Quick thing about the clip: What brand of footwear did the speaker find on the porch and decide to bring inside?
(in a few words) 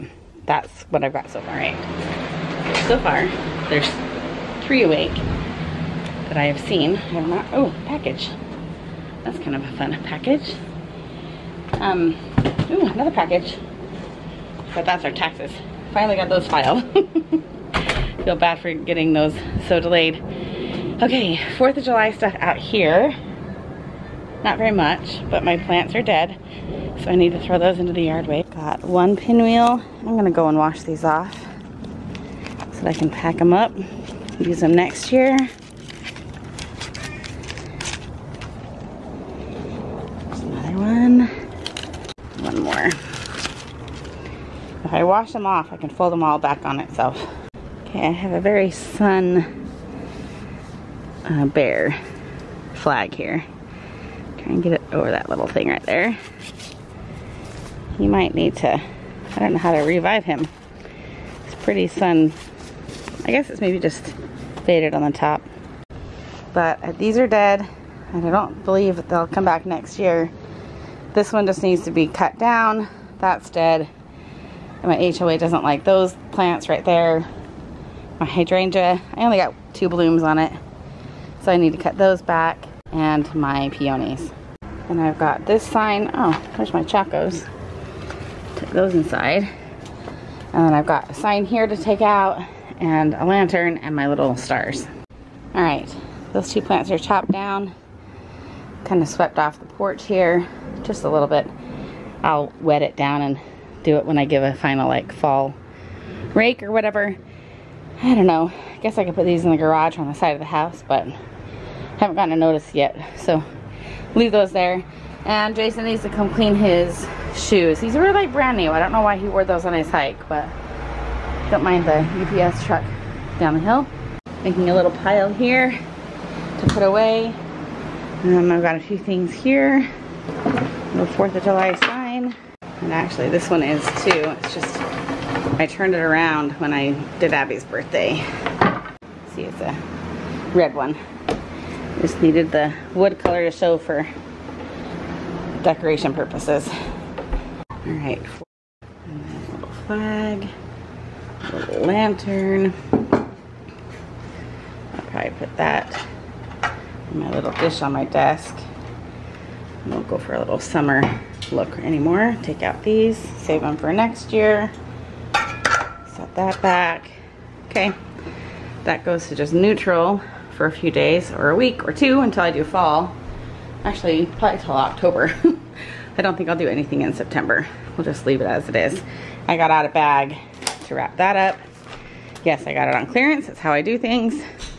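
Chacos.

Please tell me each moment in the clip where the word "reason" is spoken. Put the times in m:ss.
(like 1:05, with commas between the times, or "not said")
not said.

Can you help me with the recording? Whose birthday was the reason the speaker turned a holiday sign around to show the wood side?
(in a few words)
Abby.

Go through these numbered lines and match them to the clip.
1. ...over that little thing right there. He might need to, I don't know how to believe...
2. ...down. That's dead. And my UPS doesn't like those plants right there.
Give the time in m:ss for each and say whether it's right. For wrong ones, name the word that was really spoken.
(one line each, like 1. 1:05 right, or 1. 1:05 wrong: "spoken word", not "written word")
1. 0:54 wrong: "revive", not "believe"
2. 1:12 wrong: "HOA", not "UPS".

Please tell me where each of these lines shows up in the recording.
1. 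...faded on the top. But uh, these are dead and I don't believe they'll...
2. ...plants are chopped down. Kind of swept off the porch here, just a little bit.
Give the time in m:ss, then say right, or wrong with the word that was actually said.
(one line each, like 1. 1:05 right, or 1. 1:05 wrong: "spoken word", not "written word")
1. 1:04 right
2. 1:36 right.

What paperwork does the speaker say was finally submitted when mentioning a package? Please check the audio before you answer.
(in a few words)
Taxes.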